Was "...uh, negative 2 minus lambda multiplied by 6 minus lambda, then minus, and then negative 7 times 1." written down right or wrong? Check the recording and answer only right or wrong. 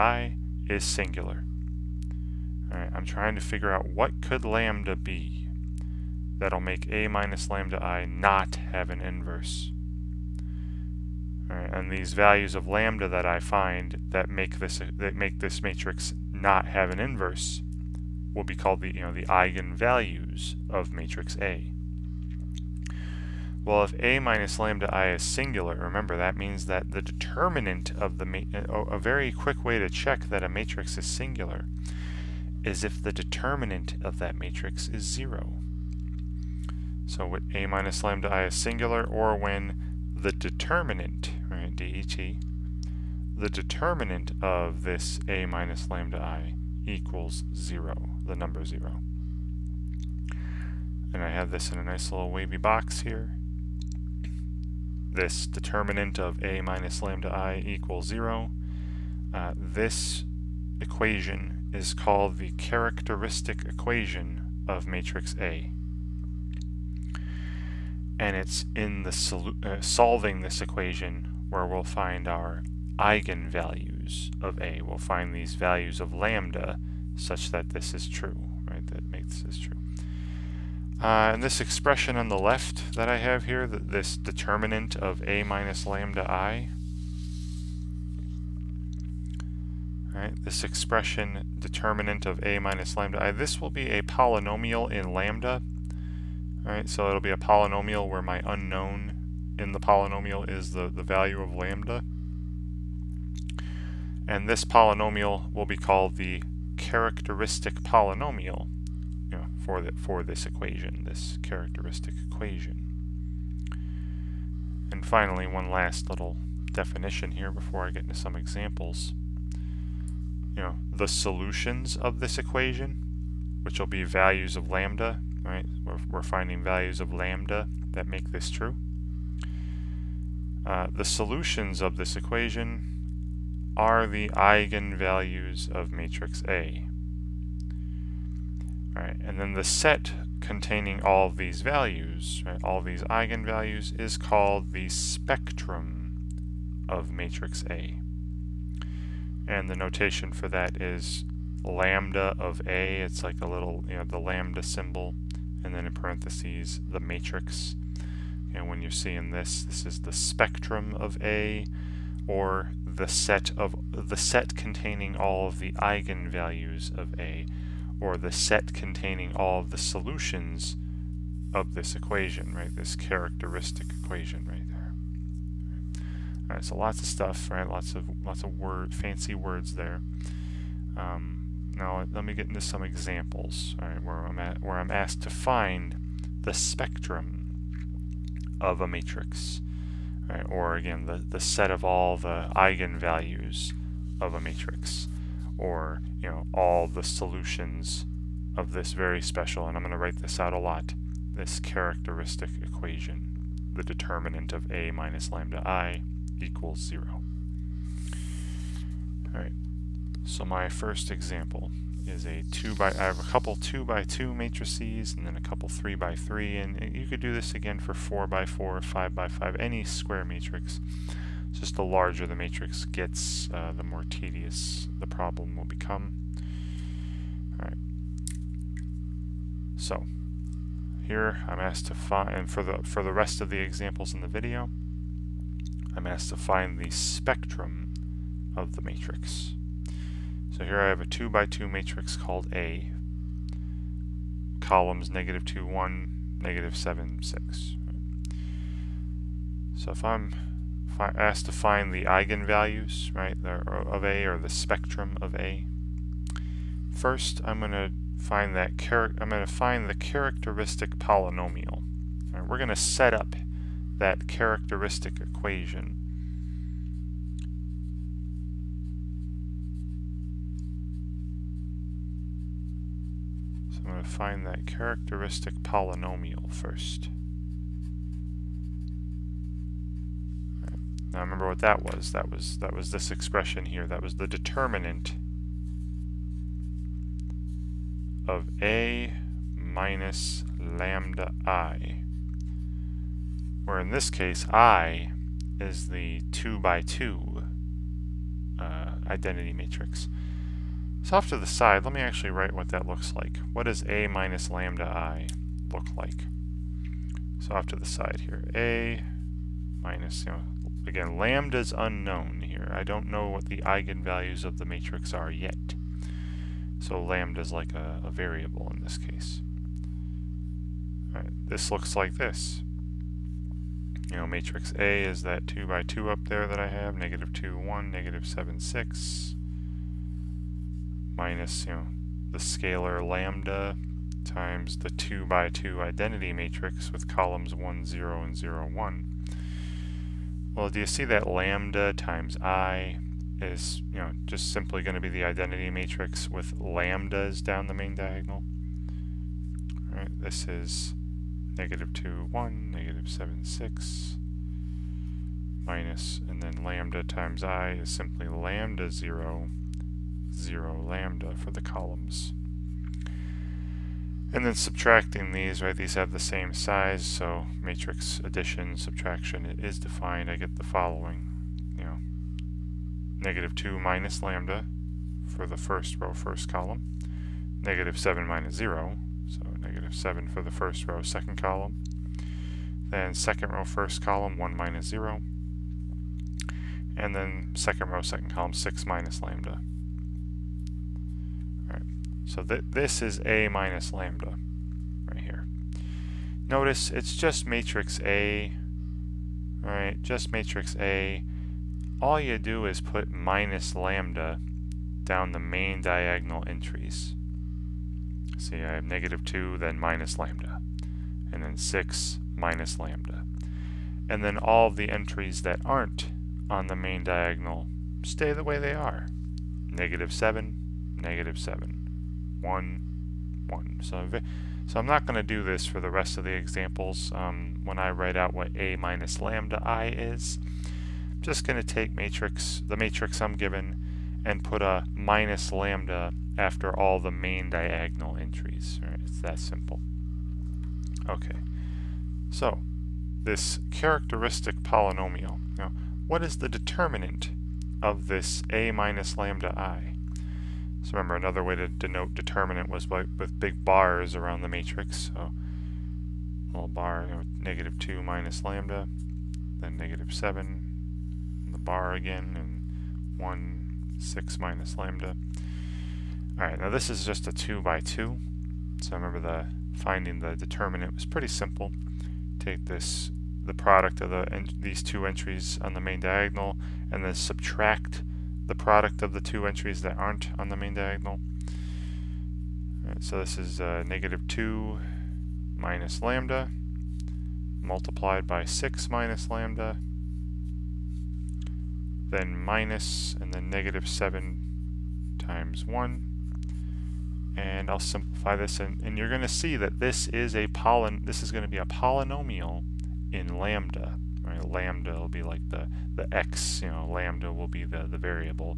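right.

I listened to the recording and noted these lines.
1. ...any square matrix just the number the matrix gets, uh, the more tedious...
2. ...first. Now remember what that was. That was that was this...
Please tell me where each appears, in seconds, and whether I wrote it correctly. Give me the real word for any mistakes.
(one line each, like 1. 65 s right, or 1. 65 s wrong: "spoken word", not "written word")
1. 219 s wrong: "larger", not "number"
2. 276 s right.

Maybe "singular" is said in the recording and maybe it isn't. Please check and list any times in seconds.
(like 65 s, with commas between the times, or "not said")
0 s, 25 s, 31 s, 38 s.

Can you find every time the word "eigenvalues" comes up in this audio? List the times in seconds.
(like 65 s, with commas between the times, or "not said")
19 s, 72 s, 134 s, 143 s, 165 s, 192 s, 252 s, 313 s.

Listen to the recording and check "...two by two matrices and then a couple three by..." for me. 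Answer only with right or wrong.
right.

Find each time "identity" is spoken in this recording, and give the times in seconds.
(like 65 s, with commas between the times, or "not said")
299 s, 335 s, 345 s.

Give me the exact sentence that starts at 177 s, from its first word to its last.
Lots of lots of word, fancy words there.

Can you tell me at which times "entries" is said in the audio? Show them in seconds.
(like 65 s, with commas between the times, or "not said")
406 s, 414 s, 438 s, 475 s, 479 s.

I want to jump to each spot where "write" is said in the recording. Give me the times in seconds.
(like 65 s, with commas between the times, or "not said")
199 s, 302 s, 427 s.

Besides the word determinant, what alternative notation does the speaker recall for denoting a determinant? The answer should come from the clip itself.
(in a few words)
big bars.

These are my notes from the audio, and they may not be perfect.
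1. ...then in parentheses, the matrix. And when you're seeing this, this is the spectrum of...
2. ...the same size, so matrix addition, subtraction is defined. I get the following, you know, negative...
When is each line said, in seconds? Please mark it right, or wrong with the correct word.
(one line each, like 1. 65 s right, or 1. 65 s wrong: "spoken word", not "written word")
1. 155 s right
2. 366 s right.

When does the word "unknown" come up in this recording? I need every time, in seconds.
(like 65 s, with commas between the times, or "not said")
98 s, 311 s.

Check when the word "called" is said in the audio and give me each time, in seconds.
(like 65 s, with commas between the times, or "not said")
18 s, 61 s, 105 s, 144 s, 242 s.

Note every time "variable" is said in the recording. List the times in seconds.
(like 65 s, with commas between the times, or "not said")
318 s, 507 s.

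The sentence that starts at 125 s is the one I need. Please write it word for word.
We're, we're finding values of lambda that make this true.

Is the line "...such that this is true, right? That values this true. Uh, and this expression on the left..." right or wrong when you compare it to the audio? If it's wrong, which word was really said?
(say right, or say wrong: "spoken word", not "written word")
wrong: "makes", not "values".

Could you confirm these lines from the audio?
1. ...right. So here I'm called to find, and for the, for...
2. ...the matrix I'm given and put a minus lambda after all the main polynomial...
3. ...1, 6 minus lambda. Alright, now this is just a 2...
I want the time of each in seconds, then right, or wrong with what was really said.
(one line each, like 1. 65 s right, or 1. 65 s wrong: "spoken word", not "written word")
1. 227 s wrong: "asked", not "called"
2. 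432 s wrong: "diagonal", not "polynomial"
3. 463 s right.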